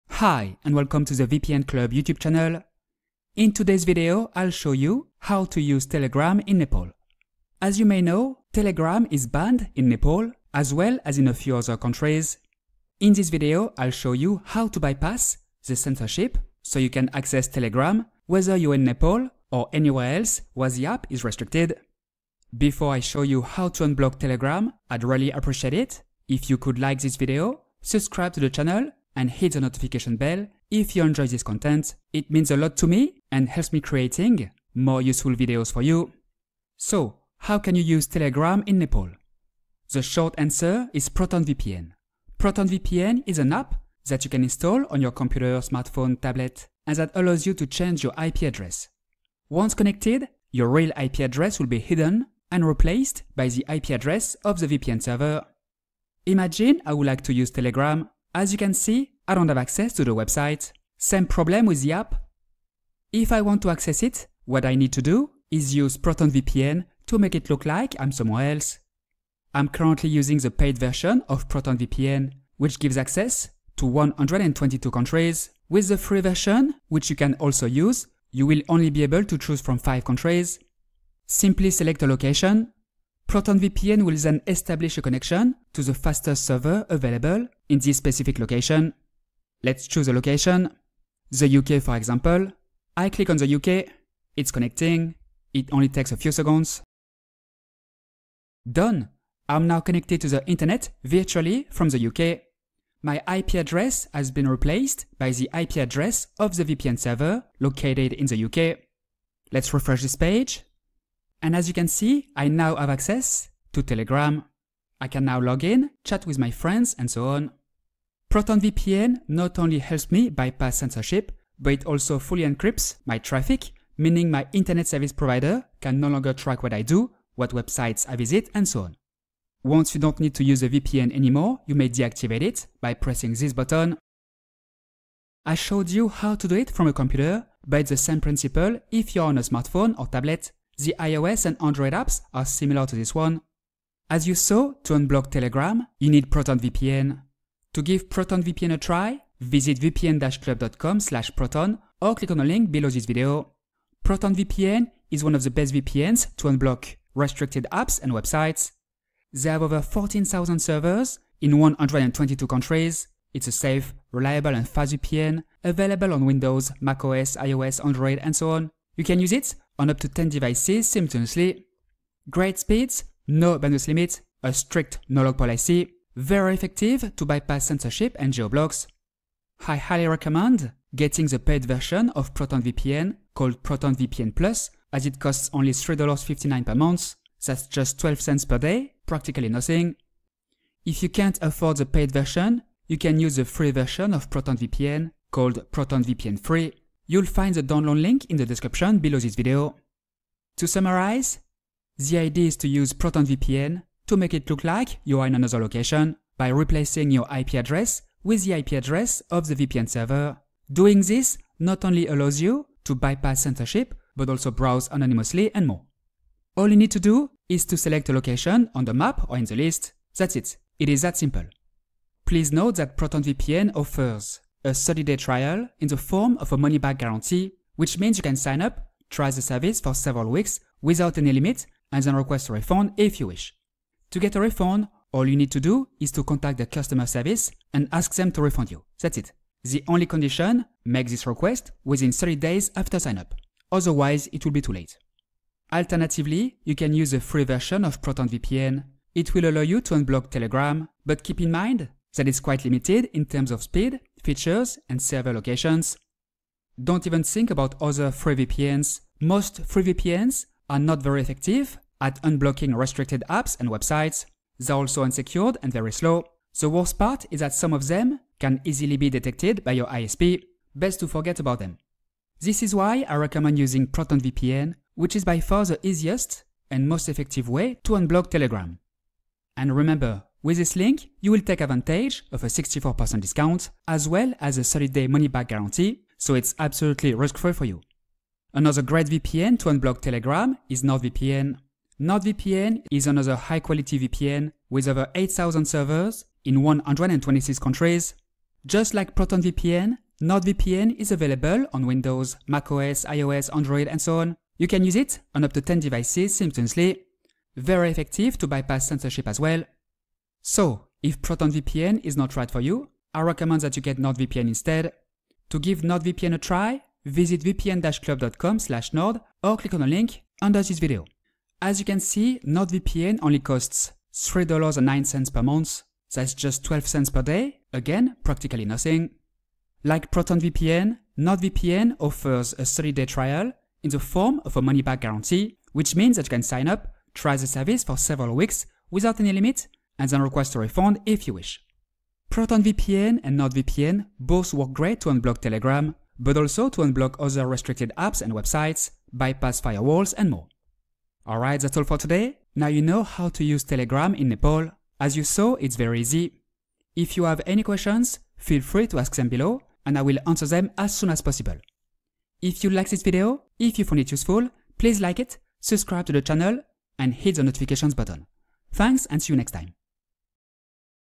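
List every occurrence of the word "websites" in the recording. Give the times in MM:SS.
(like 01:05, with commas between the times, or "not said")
01:00, 02:07, 02:38, 04:23, 05:48.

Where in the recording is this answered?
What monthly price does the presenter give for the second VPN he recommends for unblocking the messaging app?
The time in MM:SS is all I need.
05:24.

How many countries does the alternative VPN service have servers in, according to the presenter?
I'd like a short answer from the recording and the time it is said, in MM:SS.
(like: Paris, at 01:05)
126, at 04:56.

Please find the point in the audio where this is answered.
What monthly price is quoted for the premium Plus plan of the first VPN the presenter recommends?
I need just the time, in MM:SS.
03:05.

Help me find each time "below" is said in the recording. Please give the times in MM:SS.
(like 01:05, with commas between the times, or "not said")
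02:32, 03:18, 05:59.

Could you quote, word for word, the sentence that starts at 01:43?
My IP address has been replaced by the IP address of the VPN server located in the UK.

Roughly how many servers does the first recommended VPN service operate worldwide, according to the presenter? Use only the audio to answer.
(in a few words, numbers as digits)
14,000.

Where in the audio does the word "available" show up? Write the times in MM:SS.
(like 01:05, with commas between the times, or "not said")
01:26, 02:45, 05:01.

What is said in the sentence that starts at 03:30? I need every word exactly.
Doing this not only allows you to bypass censorship, but also browse anonymously and more.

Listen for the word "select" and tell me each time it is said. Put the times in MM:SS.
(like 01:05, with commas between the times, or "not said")
01:21, 03:37.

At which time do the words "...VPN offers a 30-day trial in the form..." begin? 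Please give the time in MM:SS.
03:43.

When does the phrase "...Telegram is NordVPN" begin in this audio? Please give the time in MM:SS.
04:50.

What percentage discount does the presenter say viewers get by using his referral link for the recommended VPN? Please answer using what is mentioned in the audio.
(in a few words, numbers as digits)
64%.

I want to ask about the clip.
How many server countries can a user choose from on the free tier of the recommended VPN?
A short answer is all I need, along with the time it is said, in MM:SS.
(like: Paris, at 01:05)
5, at 01:19.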